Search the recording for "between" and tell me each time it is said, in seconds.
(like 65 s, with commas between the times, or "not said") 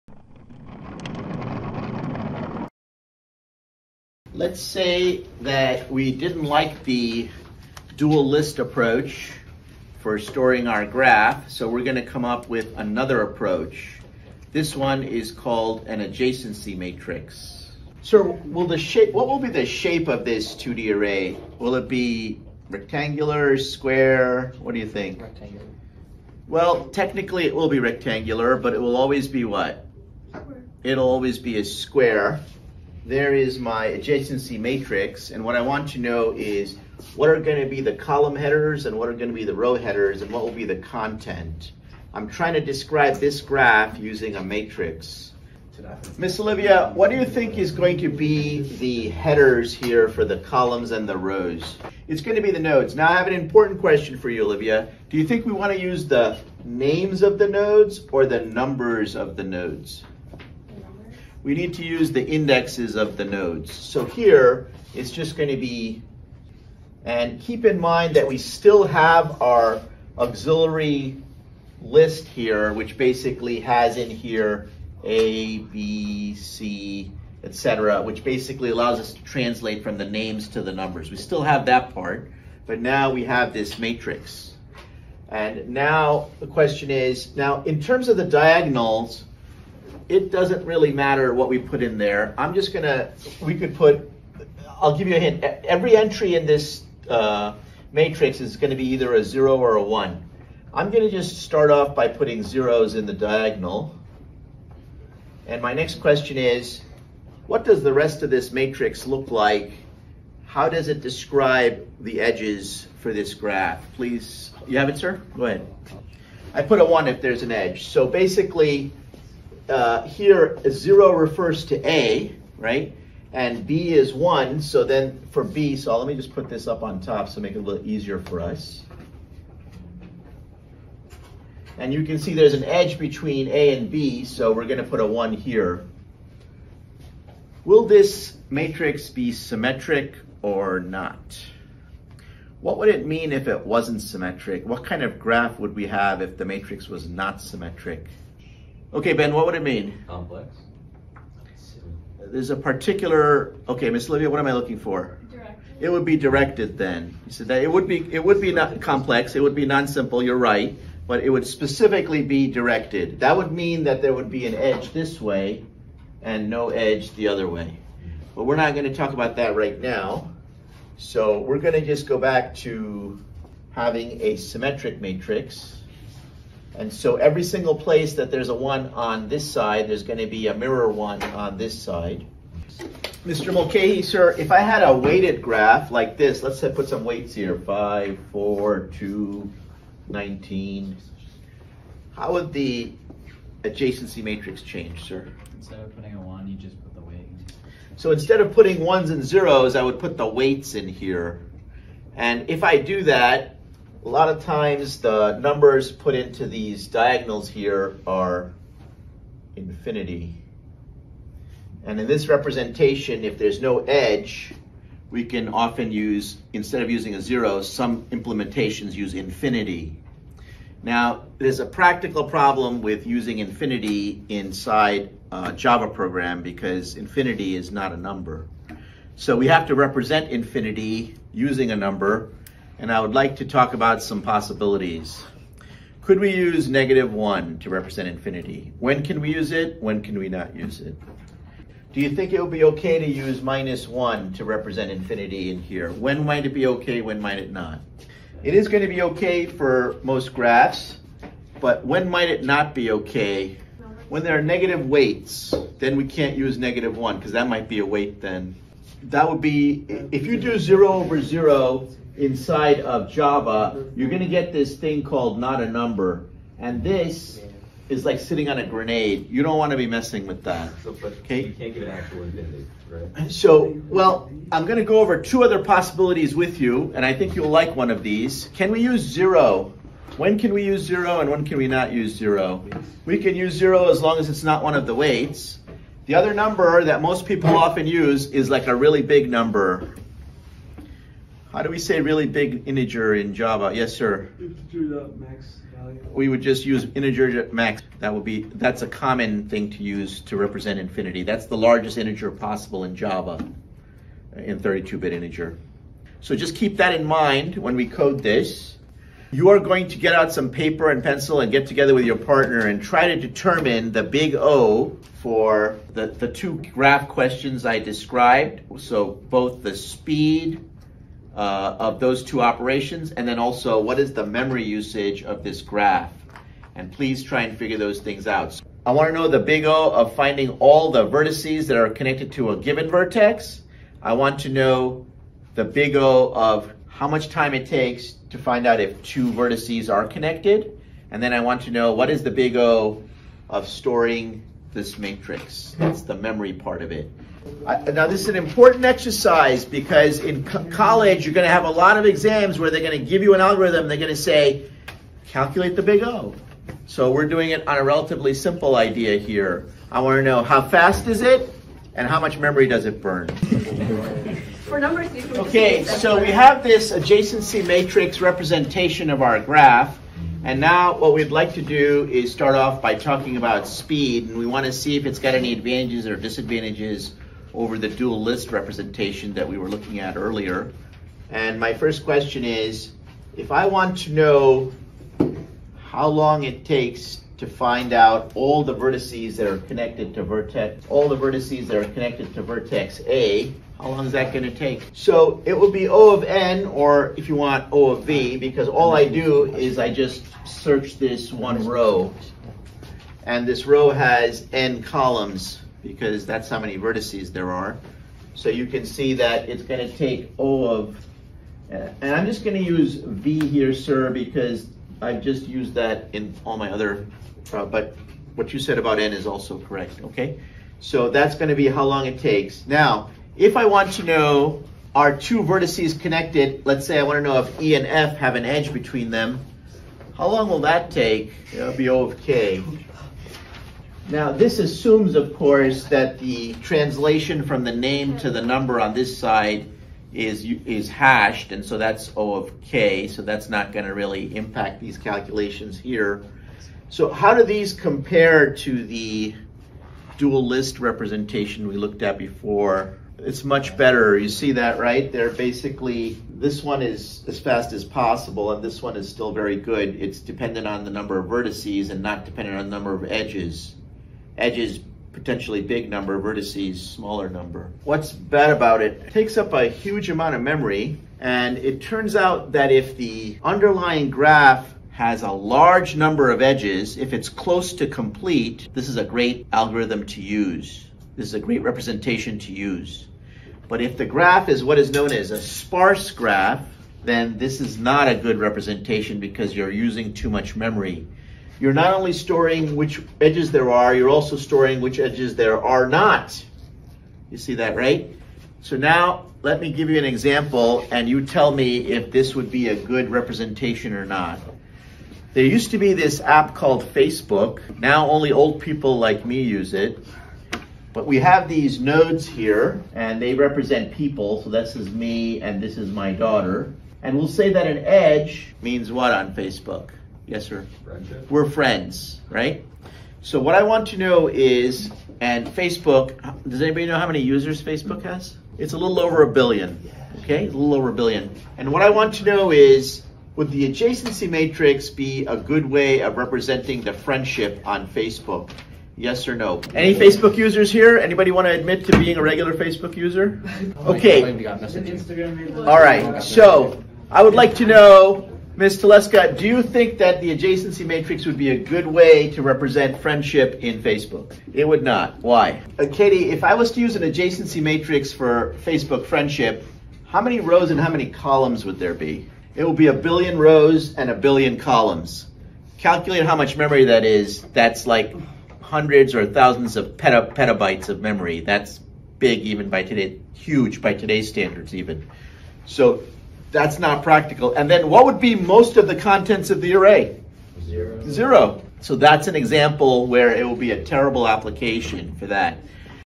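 132 s, 428 s.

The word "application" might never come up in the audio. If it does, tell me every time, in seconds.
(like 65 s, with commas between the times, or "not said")
584 s.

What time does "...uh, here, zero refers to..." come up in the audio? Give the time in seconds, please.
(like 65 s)
119 s.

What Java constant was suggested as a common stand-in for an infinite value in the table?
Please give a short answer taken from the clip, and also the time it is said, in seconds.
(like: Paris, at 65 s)
Integer max value, at 294 s.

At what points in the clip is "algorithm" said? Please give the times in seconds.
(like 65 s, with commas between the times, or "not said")
353 s, 479 s.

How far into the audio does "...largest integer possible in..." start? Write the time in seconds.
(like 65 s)
301 s.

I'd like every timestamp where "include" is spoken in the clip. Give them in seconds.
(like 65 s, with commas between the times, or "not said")
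not said.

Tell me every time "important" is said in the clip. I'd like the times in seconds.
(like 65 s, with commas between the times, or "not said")
53 s, 348 s.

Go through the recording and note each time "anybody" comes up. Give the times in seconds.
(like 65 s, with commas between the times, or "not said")
526 s, 540 s.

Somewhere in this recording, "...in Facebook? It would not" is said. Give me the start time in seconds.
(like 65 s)
553 s.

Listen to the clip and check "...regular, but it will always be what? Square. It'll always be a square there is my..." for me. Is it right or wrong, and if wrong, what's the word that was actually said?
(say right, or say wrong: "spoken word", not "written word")
wrong: "rectangular", not "regular".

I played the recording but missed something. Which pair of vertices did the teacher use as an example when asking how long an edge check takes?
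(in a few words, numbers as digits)
E and F.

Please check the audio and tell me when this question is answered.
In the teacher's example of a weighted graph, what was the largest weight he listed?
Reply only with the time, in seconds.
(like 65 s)
190 s.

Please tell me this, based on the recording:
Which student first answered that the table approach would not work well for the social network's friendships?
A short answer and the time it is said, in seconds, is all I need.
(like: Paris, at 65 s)
Ms. Telesca, at 548 s.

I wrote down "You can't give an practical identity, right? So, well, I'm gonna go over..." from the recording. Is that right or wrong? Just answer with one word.
wrong.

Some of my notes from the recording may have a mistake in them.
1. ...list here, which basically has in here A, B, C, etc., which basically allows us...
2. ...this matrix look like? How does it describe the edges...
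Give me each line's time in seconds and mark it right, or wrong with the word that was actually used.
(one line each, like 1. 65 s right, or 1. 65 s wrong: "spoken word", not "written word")
1. 71 s right
2. 108 s right.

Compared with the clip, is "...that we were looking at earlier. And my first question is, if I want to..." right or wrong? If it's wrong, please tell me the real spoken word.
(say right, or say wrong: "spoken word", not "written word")
right.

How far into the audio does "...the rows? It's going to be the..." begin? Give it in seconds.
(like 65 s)
51 s.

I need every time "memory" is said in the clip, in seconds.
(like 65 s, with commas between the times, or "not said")
324 s, 346 s, 362 s, 470 s, 490 s, 566 s, 570 s.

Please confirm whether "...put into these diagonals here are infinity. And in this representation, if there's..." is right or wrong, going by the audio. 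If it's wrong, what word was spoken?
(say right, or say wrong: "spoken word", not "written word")
right.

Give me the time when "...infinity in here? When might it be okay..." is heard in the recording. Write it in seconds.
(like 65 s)
244 s.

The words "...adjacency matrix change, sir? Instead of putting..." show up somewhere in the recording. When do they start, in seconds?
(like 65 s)
193 s.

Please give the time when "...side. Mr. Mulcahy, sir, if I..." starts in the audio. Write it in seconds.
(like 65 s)
181 s.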